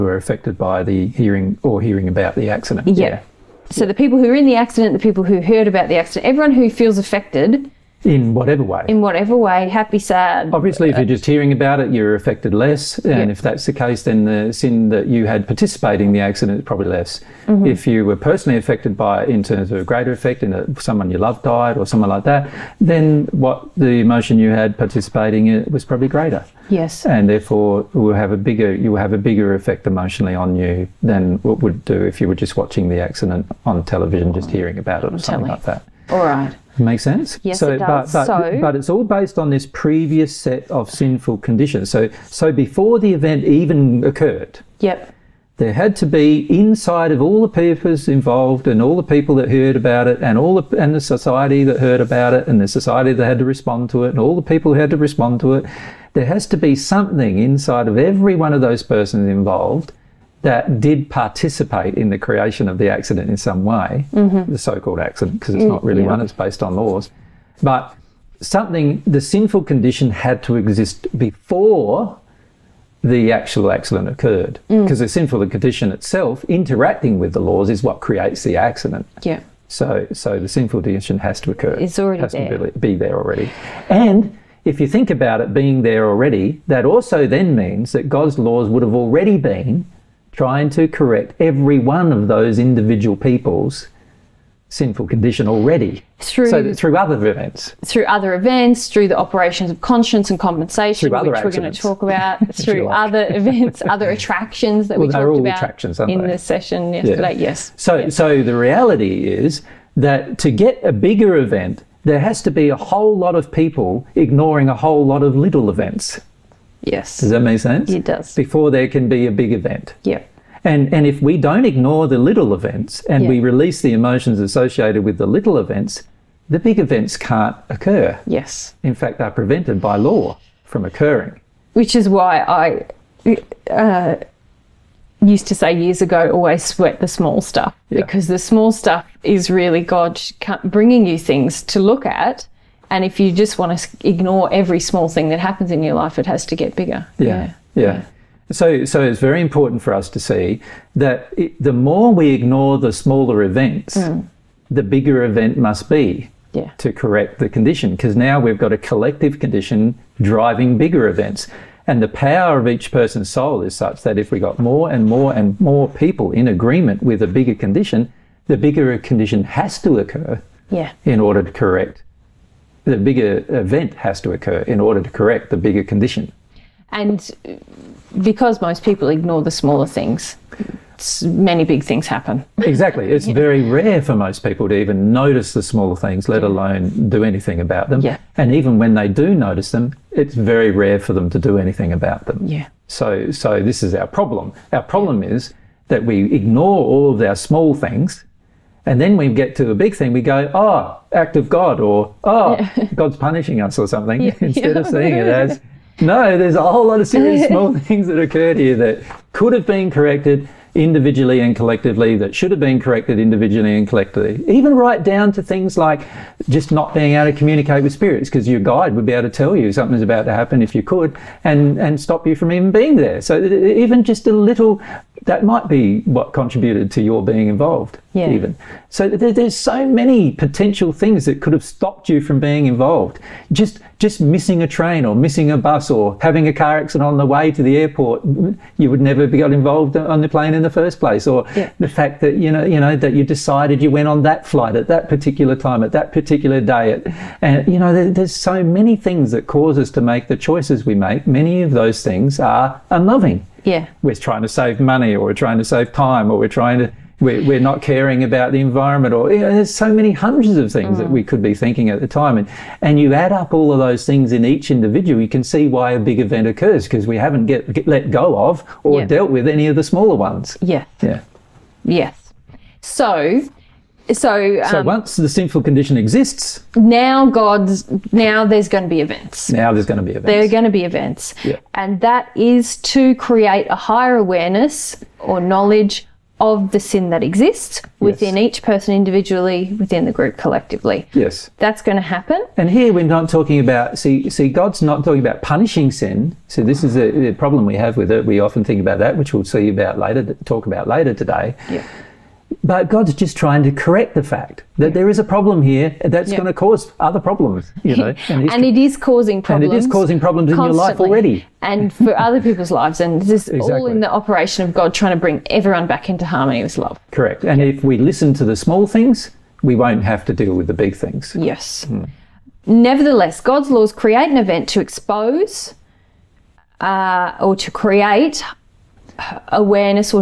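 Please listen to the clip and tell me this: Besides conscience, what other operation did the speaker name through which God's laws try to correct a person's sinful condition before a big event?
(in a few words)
Compensation.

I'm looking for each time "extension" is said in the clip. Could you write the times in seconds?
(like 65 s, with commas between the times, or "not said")
not said.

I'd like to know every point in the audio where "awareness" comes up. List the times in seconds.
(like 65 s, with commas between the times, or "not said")
284 s, 329 s.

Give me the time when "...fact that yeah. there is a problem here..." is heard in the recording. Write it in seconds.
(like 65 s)
304 s.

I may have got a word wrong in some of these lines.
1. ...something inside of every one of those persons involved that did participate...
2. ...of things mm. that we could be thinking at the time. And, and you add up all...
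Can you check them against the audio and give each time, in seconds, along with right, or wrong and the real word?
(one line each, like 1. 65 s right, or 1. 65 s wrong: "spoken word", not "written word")
1. 56 s right
2. 260 s right.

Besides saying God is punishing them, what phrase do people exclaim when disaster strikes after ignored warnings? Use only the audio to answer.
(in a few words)
Act of God.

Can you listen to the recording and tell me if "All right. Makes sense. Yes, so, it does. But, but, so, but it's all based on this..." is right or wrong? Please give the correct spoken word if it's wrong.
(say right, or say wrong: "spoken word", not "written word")
right.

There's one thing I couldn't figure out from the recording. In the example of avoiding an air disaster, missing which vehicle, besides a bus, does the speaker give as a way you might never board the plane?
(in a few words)
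A train.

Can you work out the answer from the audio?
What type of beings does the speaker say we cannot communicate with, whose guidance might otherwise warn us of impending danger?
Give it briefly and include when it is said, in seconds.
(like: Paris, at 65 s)
Spirits, at 217 s.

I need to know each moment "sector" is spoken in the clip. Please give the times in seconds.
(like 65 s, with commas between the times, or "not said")
not said.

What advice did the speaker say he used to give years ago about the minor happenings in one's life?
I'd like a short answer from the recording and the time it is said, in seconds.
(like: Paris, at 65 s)
Always sweat the small stuff, at 136 s.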